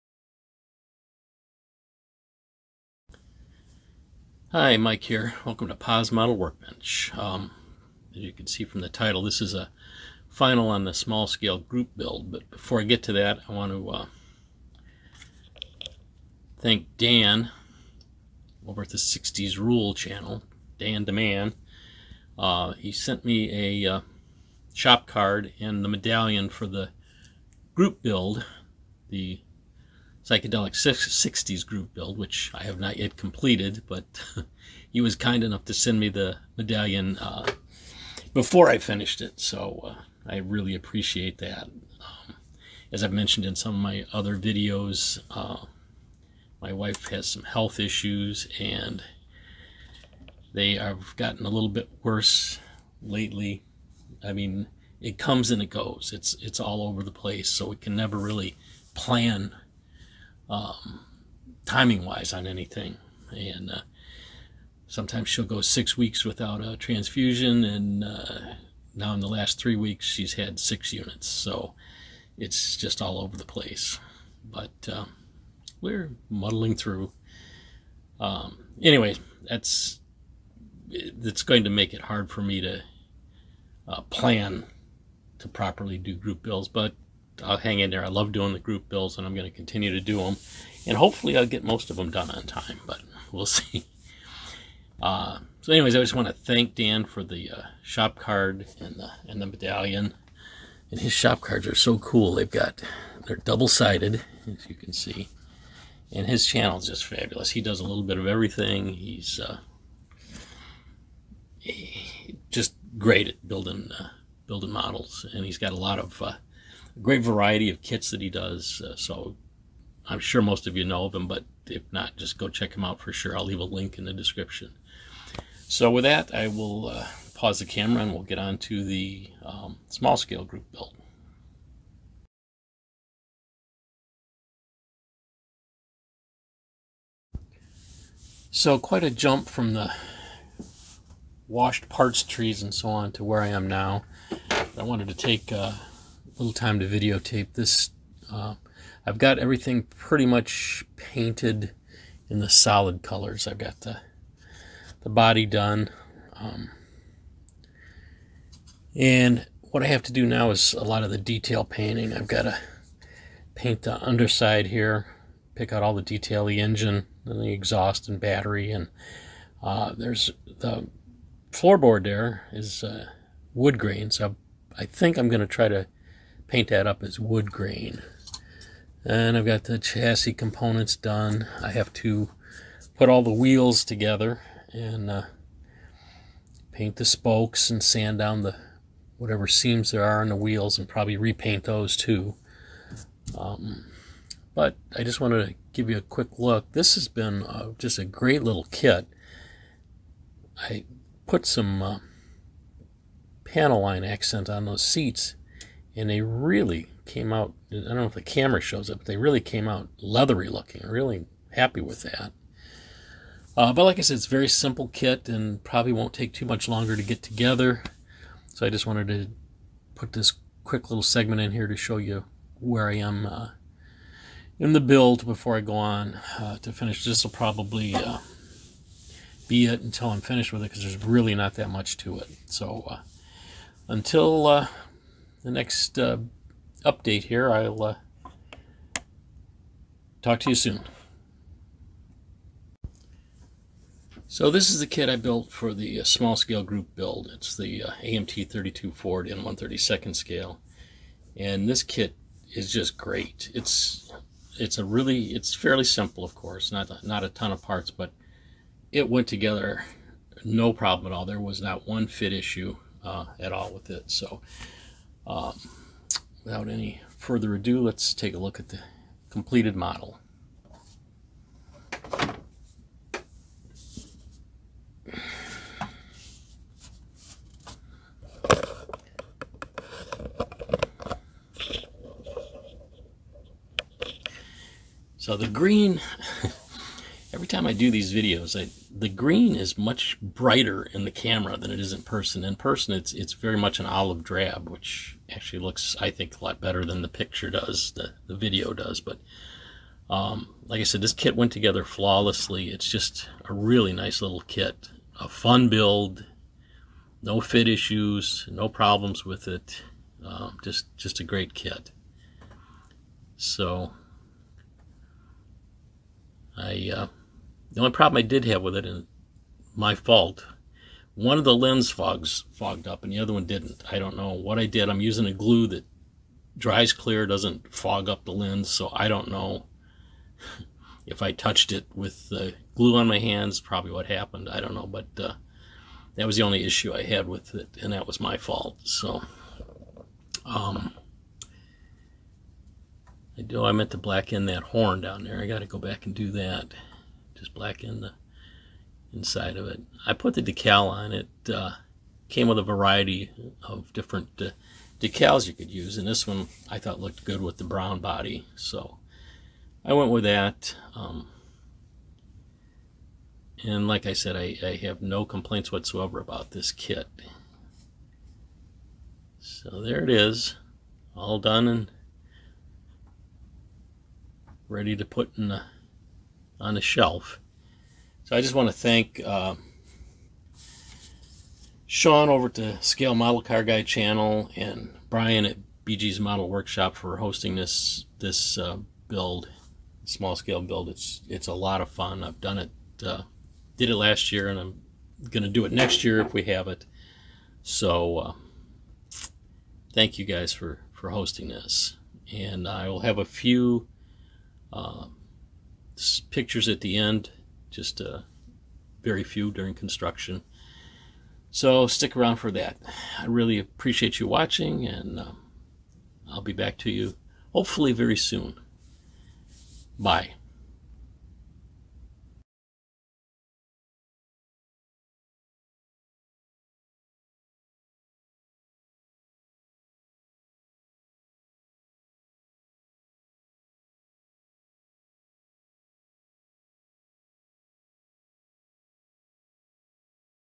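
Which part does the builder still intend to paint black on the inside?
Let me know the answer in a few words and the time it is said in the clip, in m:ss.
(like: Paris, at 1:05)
horn, at 5:44.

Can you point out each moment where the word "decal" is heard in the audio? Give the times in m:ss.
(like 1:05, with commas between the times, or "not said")
5:50, 5:54.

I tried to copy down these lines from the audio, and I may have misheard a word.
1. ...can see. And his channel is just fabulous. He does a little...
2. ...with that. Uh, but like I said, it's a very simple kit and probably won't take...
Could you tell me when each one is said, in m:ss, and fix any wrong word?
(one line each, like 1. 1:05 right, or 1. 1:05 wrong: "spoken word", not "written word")
1. 1:44 right
2. 3:31 right.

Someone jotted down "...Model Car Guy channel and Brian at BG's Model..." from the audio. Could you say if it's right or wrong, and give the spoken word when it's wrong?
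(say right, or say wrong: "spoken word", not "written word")
right.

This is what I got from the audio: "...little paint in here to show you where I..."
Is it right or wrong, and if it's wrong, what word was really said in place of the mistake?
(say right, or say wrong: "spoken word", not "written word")
wrong: "segment", not "paint".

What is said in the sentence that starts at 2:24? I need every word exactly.
I wanted to take uh, little time to videotape this.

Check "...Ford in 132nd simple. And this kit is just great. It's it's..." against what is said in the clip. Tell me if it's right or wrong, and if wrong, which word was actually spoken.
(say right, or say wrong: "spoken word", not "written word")
wrong: "scale", not "simple".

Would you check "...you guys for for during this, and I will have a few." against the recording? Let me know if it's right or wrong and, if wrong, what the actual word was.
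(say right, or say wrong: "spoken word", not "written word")
wrong: "hosting", not "during".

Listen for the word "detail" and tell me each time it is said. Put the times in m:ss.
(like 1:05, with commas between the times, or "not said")
2:41, 2:46.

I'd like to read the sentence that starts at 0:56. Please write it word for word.
It's it's all over the place, so we can never really plan um, timing wise on anything.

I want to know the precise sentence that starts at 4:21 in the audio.
There was not one fit issue uh, at all with it.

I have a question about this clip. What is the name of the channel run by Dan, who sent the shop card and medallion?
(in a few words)
60s Rule.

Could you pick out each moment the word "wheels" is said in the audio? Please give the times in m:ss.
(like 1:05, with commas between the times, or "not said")
3:03, 3:10.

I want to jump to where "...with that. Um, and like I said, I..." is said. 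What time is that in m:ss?
6:00.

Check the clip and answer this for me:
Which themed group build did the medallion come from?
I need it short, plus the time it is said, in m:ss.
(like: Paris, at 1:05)
psychedelic 60s group build, at 0:30.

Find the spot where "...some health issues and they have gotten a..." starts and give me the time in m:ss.
0:47.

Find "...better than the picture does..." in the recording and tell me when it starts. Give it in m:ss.
4:56.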